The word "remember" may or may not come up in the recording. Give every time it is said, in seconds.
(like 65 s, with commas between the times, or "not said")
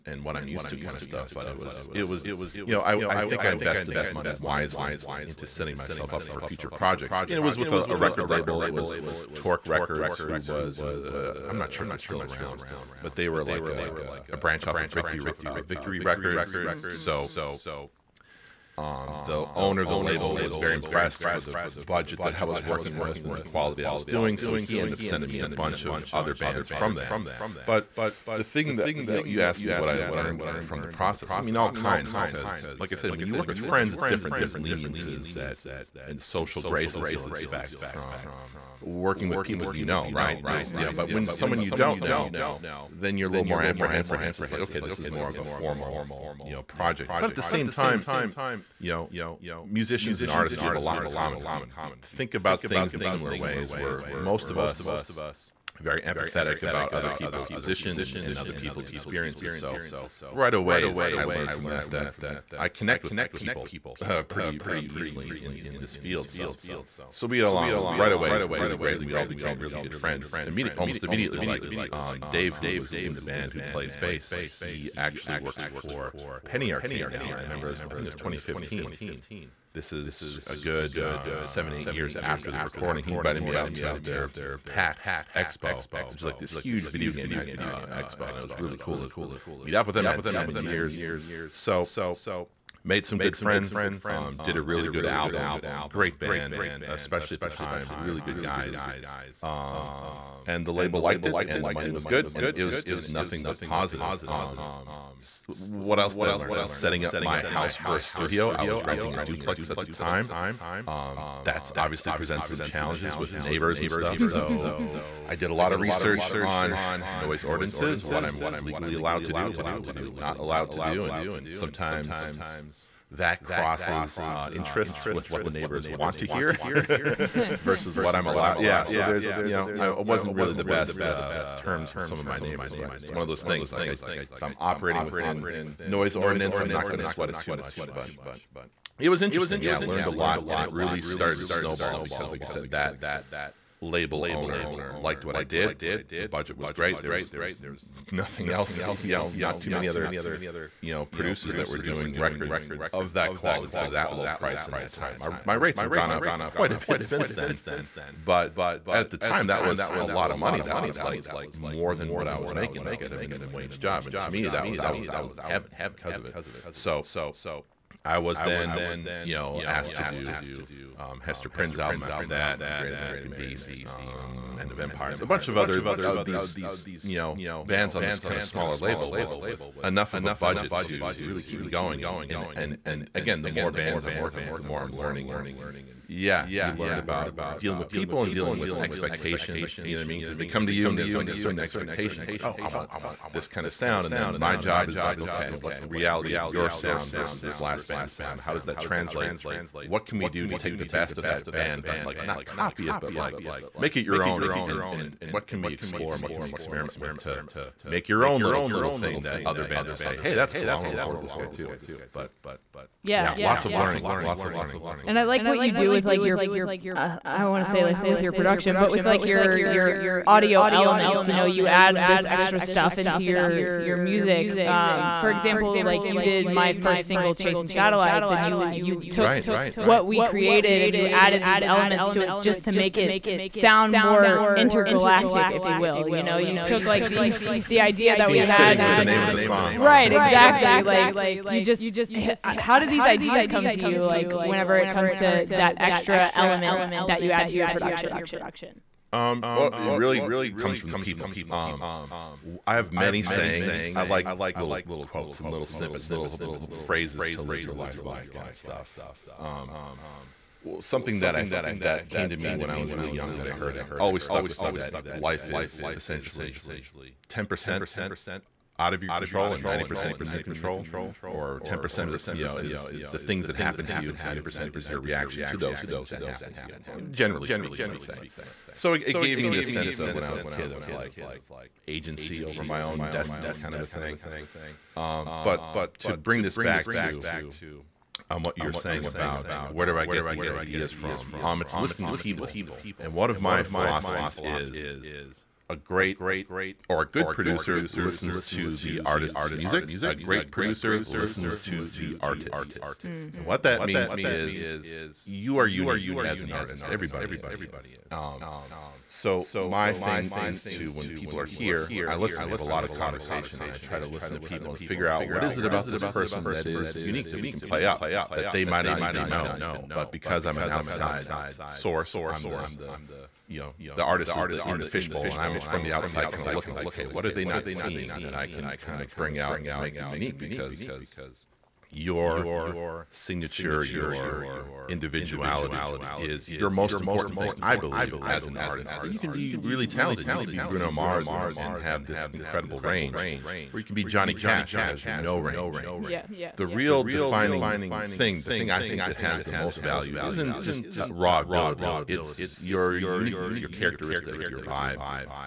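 77 s.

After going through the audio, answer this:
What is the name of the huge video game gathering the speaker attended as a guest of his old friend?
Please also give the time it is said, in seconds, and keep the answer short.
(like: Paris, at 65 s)
PAX Expo, at 84 s.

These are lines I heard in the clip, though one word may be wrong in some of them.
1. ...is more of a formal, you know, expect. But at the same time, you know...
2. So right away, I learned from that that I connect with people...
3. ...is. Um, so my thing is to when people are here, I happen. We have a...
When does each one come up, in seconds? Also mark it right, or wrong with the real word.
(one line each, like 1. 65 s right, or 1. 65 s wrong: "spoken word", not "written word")
1. 44 s wrong: "project", not "expect"
2. 59 s right
3. 307 s wrong: "listen", not "happen".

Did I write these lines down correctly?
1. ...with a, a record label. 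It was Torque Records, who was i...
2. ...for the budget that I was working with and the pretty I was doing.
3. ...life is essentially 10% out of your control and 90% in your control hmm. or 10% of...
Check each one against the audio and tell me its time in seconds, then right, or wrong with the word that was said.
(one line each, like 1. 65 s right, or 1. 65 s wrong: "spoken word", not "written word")
1. 7 s right
2. 21 s wrong: "quality", not "pretty"
3. 265 s right.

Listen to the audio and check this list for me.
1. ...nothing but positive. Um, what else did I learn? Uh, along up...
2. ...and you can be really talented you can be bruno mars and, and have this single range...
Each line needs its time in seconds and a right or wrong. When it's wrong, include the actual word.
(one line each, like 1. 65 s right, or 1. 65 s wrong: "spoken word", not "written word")
1. 103 s wrong: "setting", not "along"
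2. 339 s wrong: "incredible", not "single".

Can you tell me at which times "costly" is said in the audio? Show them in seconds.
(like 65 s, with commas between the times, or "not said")
not said.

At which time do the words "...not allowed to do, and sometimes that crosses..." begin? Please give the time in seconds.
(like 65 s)
120 s.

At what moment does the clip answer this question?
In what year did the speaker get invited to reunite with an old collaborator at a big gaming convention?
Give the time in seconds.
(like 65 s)
78 s.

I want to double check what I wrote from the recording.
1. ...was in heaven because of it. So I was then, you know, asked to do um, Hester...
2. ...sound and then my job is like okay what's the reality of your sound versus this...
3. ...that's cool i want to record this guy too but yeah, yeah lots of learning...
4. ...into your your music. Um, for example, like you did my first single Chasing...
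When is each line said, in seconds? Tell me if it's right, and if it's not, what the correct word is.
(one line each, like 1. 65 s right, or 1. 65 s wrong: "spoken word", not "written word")
1. 164 s right
2. 193 s right
3. 210 s right
4. 222 s right.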